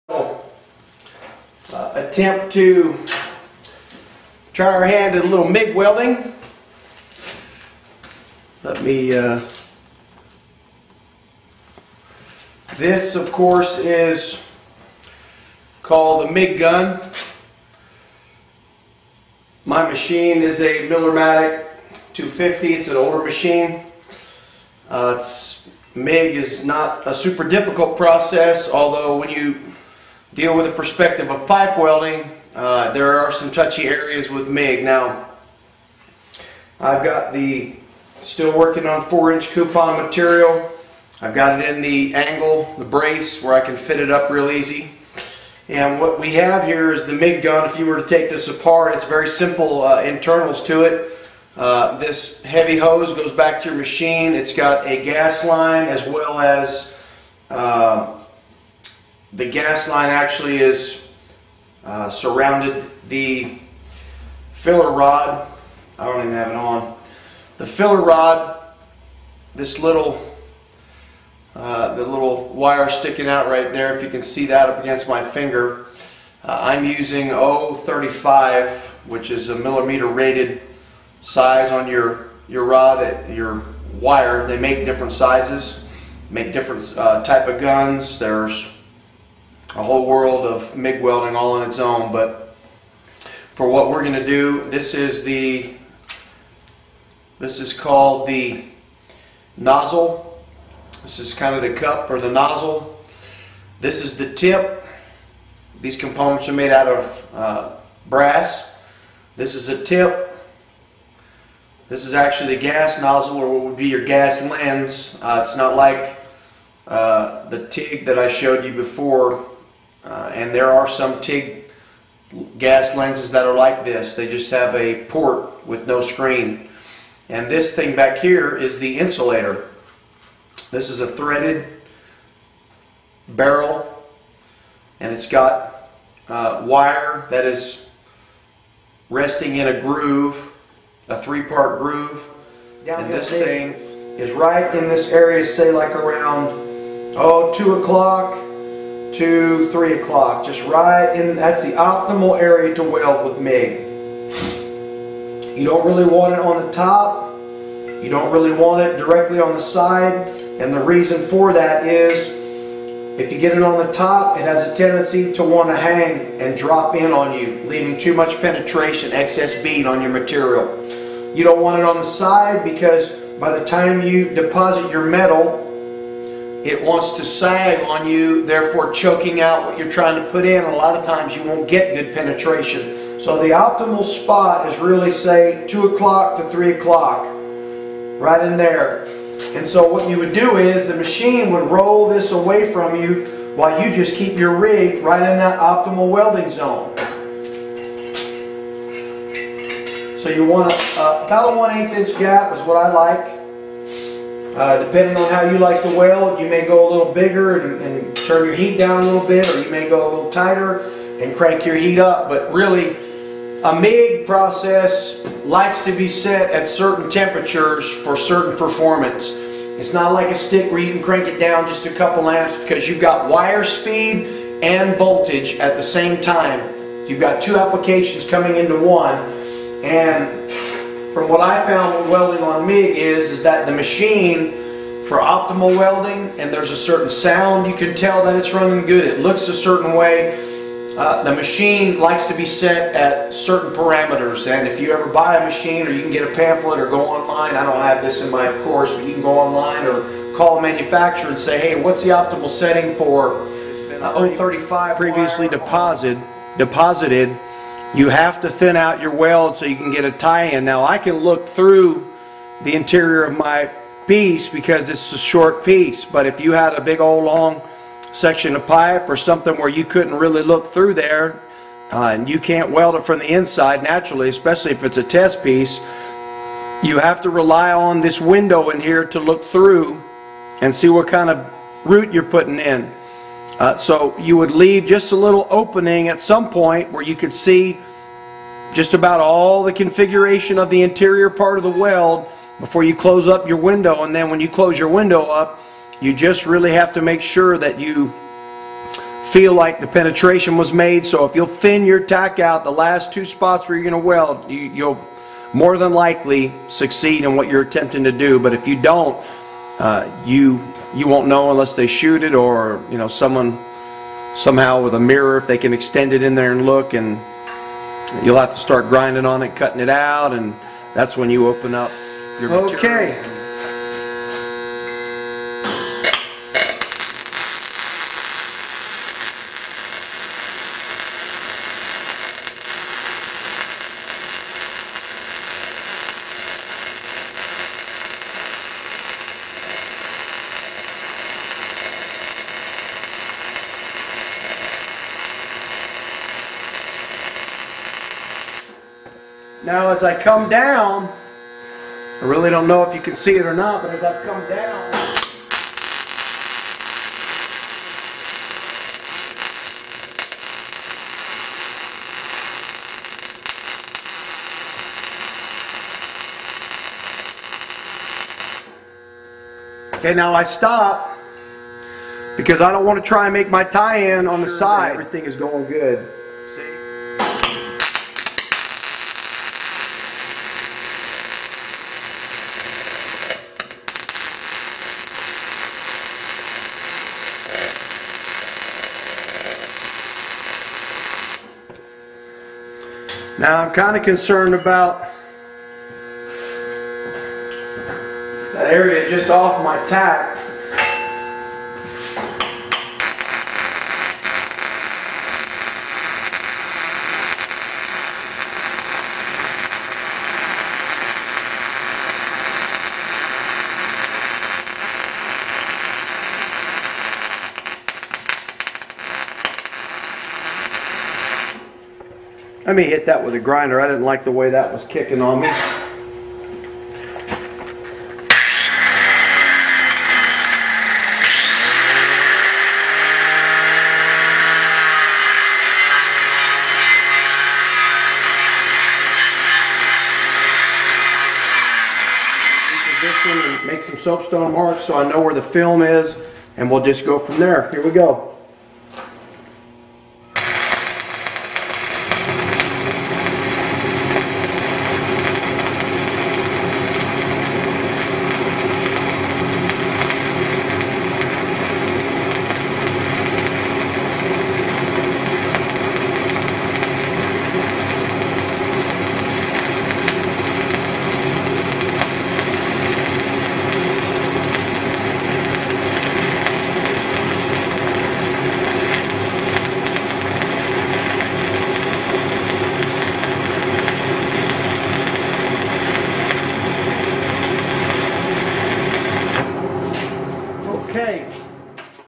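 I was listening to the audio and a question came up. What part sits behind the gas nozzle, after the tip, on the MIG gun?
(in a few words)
The insulator.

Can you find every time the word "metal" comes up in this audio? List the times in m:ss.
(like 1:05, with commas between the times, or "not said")
2:55.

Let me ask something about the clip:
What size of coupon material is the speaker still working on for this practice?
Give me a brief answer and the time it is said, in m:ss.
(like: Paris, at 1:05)
4 inch, at 0:39.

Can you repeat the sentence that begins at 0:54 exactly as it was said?
It's got a gas line as well as uh, the gas line actually is uh, surrounded the filler rod.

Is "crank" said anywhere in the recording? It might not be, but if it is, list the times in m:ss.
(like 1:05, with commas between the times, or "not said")
3:31, 3:41.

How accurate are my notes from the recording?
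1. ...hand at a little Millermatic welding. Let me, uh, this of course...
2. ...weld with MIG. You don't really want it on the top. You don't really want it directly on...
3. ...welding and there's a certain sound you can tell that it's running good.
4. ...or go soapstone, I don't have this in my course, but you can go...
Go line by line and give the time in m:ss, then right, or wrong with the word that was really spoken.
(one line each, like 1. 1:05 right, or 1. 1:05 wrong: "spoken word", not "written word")
1. 0:04 wrong: "MIG", not "Millermatic"
2. 2:32 right
3. 3:55 right
4. 4:06 wrong: "online", not "soapstone".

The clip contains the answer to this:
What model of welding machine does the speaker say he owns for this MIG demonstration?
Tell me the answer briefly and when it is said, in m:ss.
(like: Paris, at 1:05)
Millermatic 250, at 0:20.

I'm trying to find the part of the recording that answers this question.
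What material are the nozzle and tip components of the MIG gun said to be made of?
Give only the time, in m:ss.
1:48.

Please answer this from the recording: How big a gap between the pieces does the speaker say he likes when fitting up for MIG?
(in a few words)
1/8 inch.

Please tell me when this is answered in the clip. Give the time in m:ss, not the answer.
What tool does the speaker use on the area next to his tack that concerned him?
7:03.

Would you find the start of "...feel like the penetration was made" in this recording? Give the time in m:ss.
4:59.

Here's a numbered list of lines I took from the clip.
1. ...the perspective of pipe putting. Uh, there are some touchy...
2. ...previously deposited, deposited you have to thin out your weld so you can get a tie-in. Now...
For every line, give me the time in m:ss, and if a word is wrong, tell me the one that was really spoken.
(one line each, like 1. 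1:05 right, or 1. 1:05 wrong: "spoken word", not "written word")
1. 0:30 wrong: "welding", not "putting"
2. 4:14 right.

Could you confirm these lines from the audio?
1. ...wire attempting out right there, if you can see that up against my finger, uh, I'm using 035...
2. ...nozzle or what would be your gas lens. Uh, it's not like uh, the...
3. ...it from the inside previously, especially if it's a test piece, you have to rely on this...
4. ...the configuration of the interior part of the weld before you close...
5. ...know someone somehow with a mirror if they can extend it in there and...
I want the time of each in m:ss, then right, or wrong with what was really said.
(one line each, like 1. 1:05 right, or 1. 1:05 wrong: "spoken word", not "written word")
1. 1:12 wrong: "sticking", not "attempting"
2. 1:53 right
3. 4:32 wrong: "naturally", not "previously"
4. 4:49 right
5. 5:12 right.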